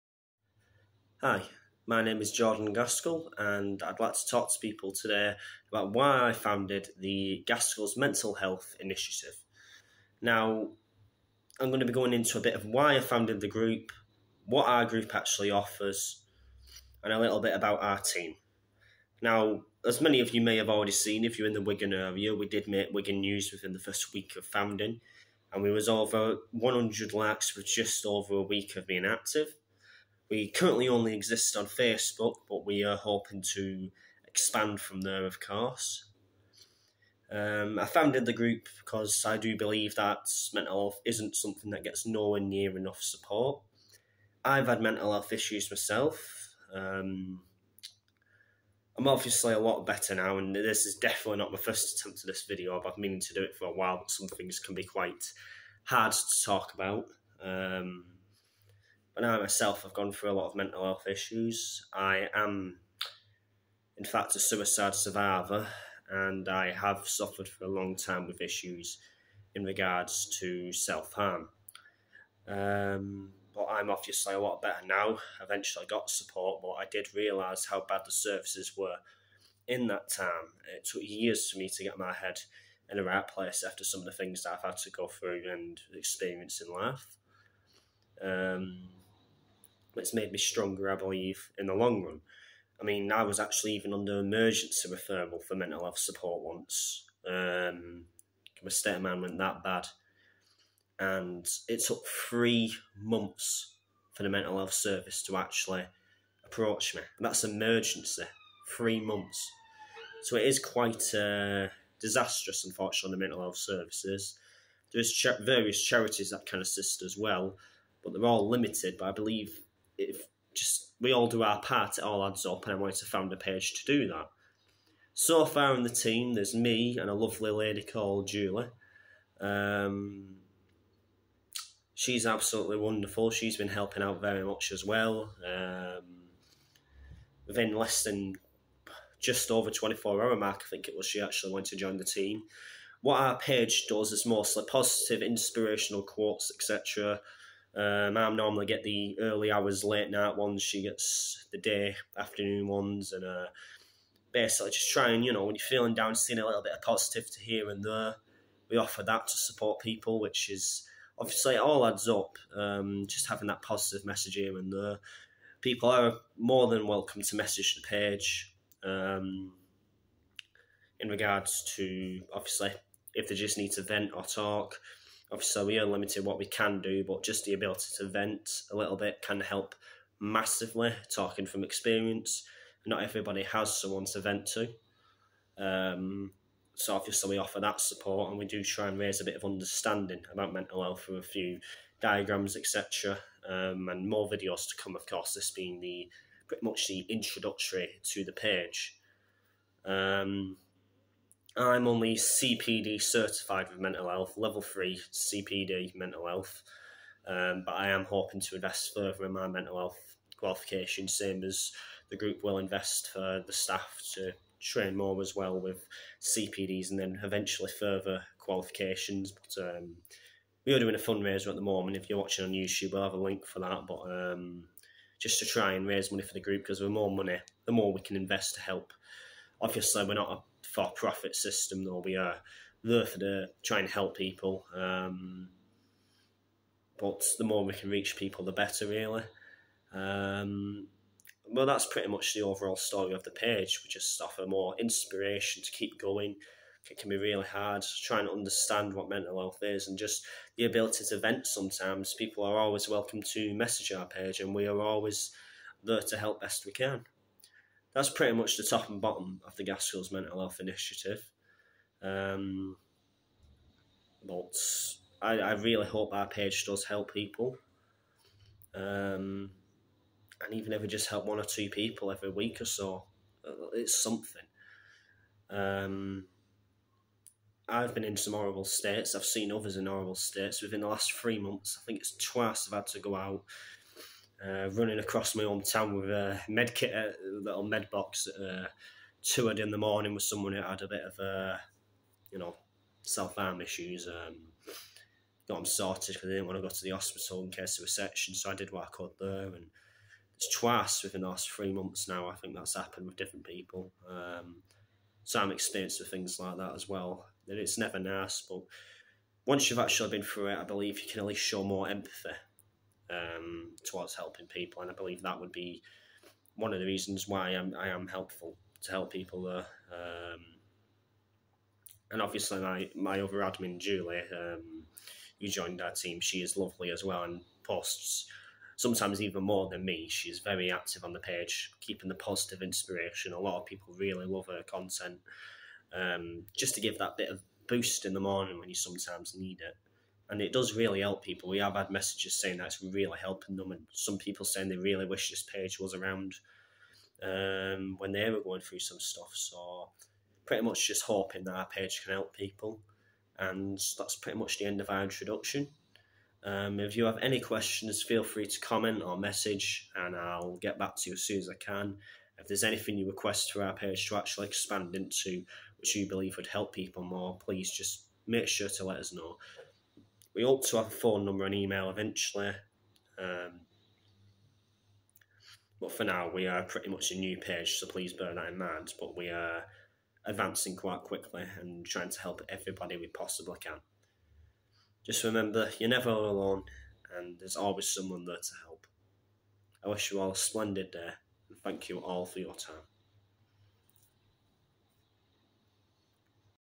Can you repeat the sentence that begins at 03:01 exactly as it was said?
Talking from experience, not everybody has someone to vent to.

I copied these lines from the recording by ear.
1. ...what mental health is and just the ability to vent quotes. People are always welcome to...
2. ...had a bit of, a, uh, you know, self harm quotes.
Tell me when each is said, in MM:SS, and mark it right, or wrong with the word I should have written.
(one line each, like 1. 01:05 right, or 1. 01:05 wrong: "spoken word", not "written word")
1. 04:08 wrong: "sometimes", not "quotes"
2. 04:50 wrong: "issues", not "quotes".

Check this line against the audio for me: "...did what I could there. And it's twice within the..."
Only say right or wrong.
right.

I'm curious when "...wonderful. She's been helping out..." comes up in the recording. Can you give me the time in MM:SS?
02:12.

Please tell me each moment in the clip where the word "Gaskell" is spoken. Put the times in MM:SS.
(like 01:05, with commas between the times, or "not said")
00:02, 00:07, 04:19.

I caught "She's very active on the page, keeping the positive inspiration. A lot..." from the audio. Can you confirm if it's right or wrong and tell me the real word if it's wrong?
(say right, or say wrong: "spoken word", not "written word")
right.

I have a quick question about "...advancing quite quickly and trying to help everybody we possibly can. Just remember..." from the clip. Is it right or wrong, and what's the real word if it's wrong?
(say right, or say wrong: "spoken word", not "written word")
right.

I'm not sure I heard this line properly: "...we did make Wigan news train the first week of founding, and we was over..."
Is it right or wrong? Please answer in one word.
wrong.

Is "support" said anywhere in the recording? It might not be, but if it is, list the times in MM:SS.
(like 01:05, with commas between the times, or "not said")
00:43, 01:16, 01:35, 02:39, 03:07.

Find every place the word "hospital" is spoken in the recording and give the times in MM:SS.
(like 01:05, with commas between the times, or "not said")
04:56.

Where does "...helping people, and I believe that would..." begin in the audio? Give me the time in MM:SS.
05:14.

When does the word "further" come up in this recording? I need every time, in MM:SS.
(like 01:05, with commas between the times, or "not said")
03:28, 03:37.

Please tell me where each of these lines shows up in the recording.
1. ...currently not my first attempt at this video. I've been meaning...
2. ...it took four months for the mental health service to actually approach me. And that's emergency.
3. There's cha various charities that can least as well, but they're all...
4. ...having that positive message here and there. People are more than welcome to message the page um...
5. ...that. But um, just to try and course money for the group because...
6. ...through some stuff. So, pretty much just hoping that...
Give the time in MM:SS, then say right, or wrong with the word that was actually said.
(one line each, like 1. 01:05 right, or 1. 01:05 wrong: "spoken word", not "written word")
1. 00:50 wrong: "definitely", not "currently"
2. 01:41 wrong: "three", not "four"
3. 01:54 wrong: "assist", not "least"
4. 02:43 right
5. 03:43 wrong: "raise", not "course"
6. 05:48 right.